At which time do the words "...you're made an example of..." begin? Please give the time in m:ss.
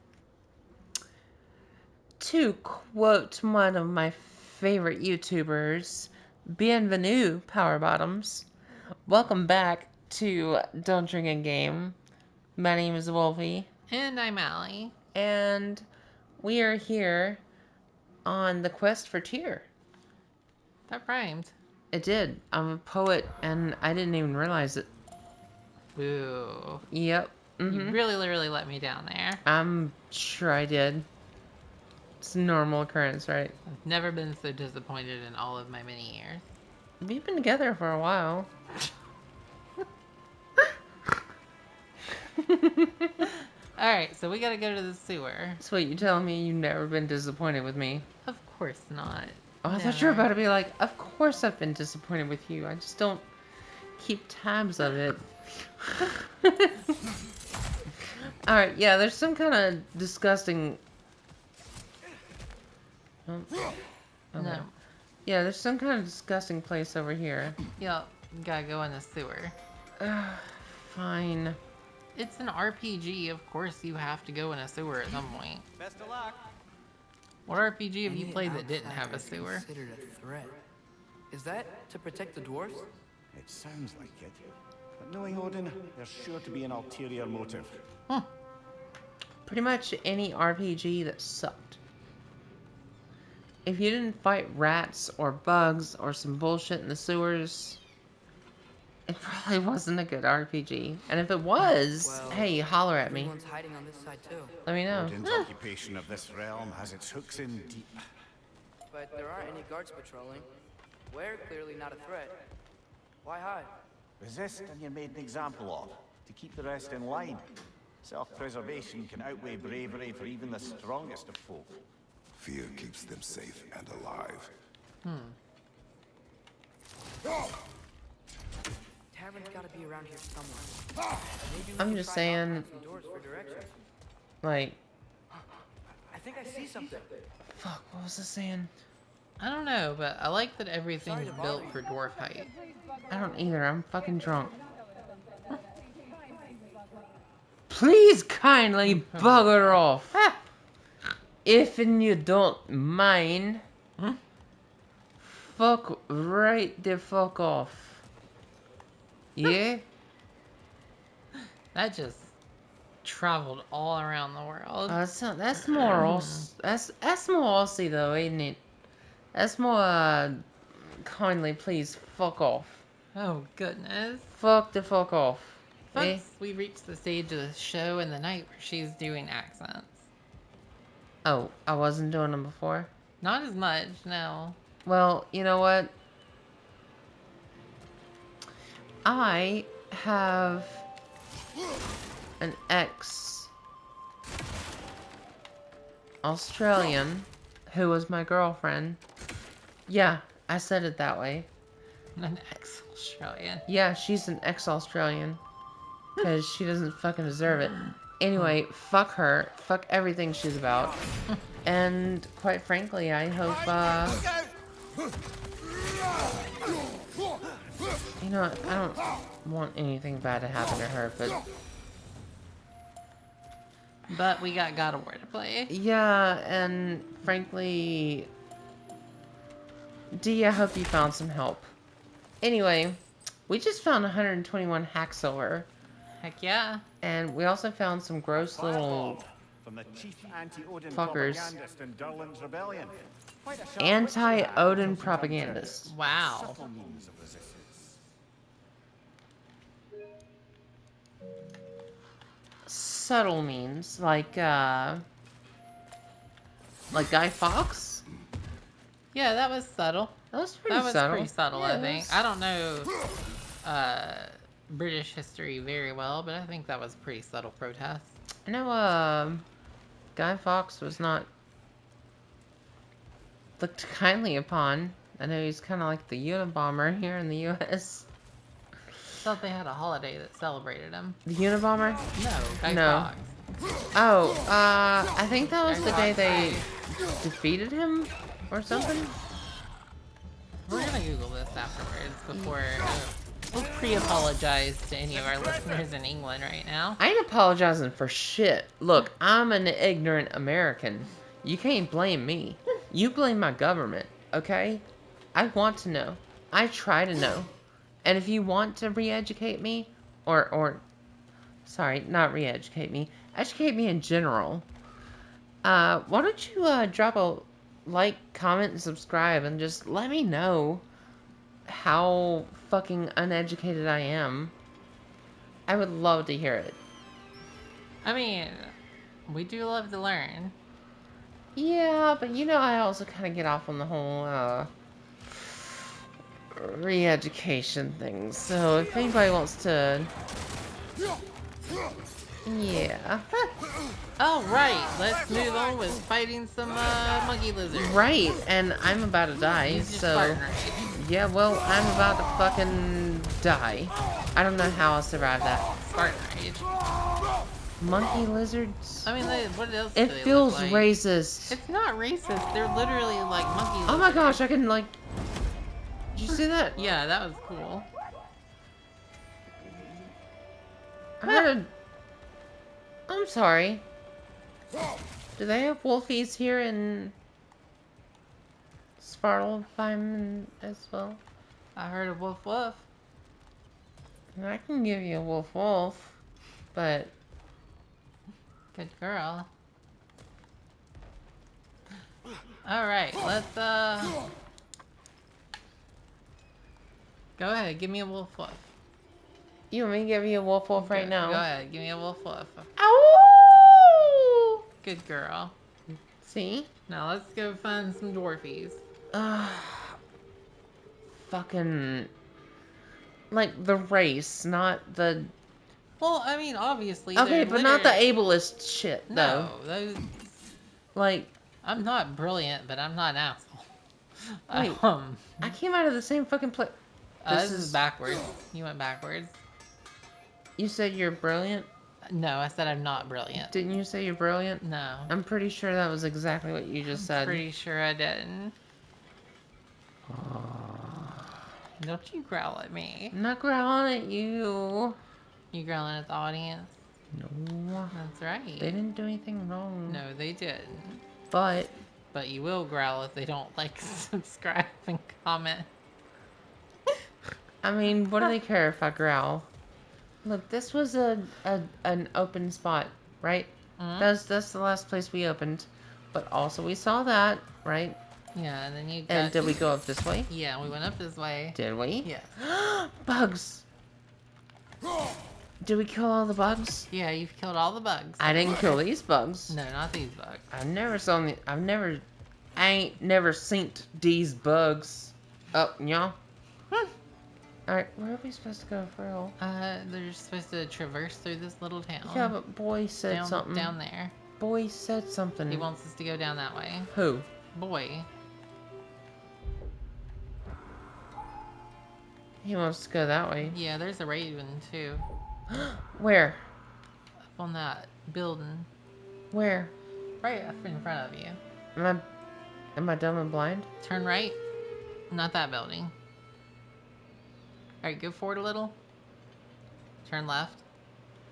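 1:54.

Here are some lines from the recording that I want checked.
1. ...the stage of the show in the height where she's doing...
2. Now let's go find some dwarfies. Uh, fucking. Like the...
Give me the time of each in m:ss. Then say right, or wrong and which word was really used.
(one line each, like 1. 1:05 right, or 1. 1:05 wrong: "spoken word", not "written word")
1. 2:56 wrong: "night", not "height"
2. 6:46 right.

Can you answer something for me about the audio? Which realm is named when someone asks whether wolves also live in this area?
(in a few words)
Svartalfheim.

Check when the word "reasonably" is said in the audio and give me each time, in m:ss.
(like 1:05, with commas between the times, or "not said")
not said.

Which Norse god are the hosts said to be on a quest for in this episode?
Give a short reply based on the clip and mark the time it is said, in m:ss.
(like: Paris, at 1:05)
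Tyr, at 0:19.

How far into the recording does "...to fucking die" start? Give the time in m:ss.
5:52.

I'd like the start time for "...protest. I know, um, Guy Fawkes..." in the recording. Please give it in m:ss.
4:27.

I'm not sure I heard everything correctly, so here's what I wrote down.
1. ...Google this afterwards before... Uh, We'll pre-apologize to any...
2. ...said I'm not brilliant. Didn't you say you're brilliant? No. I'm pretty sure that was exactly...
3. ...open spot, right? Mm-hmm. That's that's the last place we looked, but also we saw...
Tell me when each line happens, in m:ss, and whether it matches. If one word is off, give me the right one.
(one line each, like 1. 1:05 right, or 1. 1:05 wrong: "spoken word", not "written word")
1. 4:51 right
2. 7:12 right
3. 7:42 wrong: "opened", not "looked".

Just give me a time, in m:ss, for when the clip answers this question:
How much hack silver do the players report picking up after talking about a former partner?
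3:54.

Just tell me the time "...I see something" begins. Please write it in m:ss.
2:16.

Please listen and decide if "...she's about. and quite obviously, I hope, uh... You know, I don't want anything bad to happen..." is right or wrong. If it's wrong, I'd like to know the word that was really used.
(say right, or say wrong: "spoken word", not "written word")
wrong: "frankly", not "obviously".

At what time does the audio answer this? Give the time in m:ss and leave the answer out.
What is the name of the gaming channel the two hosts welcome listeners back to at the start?
0:10.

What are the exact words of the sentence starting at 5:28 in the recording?
I mean, we do love to learn.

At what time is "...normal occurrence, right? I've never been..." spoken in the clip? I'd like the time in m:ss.
0:32.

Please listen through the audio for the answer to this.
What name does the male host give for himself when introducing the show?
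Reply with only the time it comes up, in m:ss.
0:13.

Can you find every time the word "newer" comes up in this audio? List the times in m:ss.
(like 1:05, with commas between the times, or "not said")
not said.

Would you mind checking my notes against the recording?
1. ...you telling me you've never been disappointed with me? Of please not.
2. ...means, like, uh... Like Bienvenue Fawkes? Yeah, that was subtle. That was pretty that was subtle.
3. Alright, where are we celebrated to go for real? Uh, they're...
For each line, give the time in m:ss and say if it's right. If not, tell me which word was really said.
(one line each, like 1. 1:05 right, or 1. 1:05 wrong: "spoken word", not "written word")
1. 0:45 wrong: "course", not "please"
2. 4:13 wrong: "Guy", not "Bienvenue"
3. 8:07 wrong: "supposed", not "celebrated".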